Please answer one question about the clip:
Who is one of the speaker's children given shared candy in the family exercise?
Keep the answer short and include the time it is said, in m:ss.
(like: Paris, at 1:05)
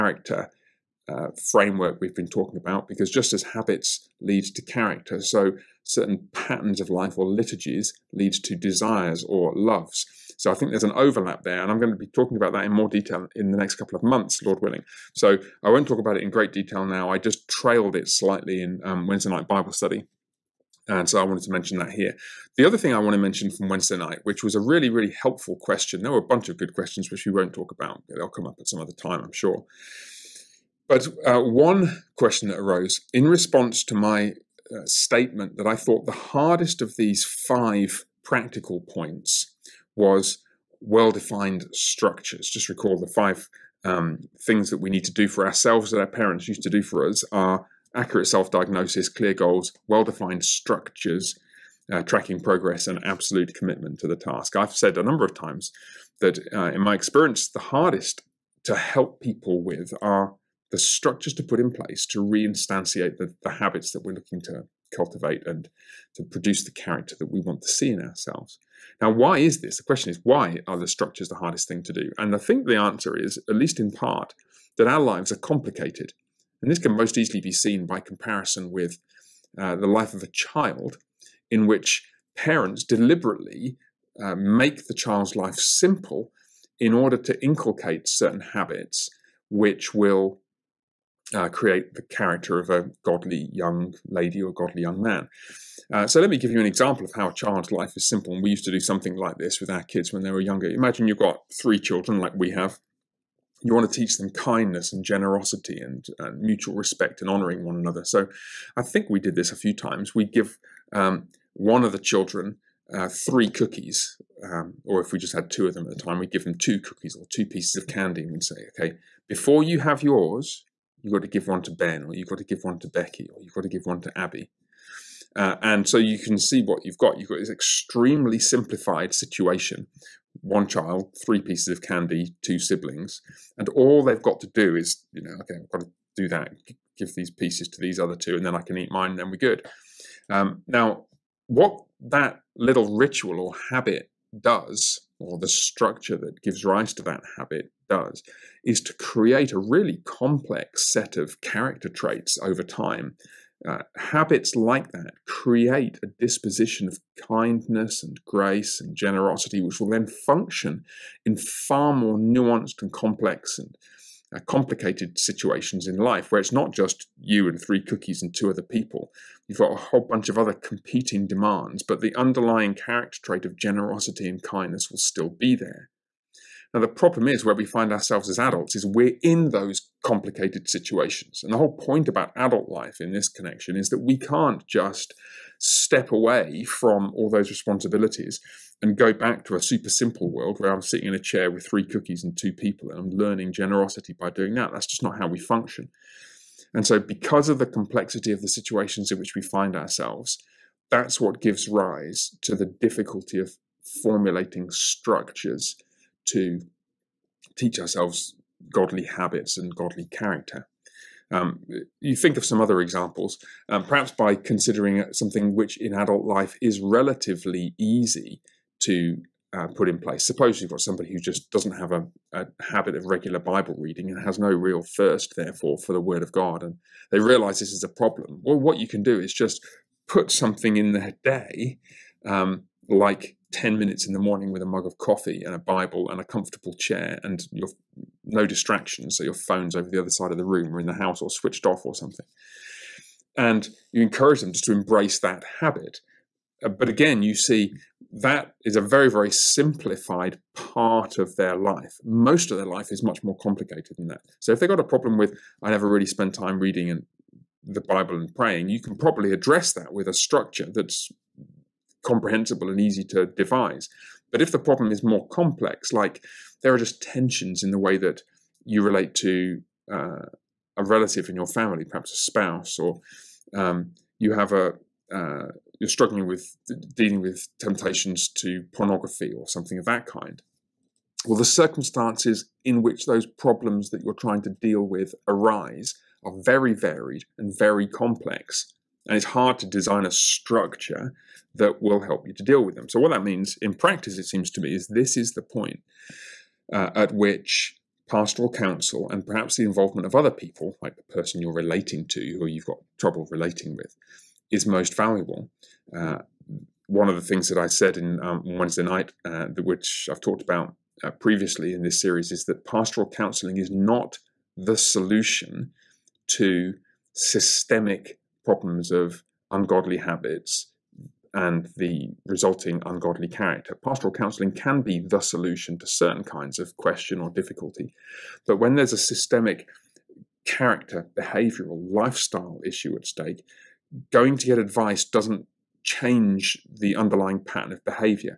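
Ben, at 2:01.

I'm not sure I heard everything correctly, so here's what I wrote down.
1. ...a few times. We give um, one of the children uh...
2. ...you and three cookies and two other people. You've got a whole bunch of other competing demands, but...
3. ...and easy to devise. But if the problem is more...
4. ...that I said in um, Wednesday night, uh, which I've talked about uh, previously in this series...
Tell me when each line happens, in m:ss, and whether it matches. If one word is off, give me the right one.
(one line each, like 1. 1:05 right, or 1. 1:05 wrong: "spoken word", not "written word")
1. 1:49 right
2. 2:47 right
3. 4:22 right
4. 5:07 right.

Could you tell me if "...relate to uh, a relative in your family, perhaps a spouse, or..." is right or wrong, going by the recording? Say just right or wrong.
right.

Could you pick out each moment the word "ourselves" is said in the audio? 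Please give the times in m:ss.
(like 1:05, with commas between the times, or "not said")
0:45, 1:08, 2:57, 3:19, 3:27.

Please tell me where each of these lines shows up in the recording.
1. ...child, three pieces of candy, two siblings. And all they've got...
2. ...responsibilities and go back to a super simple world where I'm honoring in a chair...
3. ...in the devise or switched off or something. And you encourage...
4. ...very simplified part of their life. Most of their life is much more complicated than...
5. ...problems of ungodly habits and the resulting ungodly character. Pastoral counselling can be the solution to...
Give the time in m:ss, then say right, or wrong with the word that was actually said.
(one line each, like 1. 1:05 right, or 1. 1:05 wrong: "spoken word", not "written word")
1. 2:10 right
2. 3:07 wrong: "sitting", not "honoring"
3. 4:00 wrong: "house", not "devise"
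4. 4:09 right
5. 5:18 right.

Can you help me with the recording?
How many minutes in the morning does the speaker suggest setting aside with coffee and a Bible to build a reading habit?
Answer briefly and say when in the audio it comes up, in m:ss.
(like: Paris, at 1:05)
10, at 3:53.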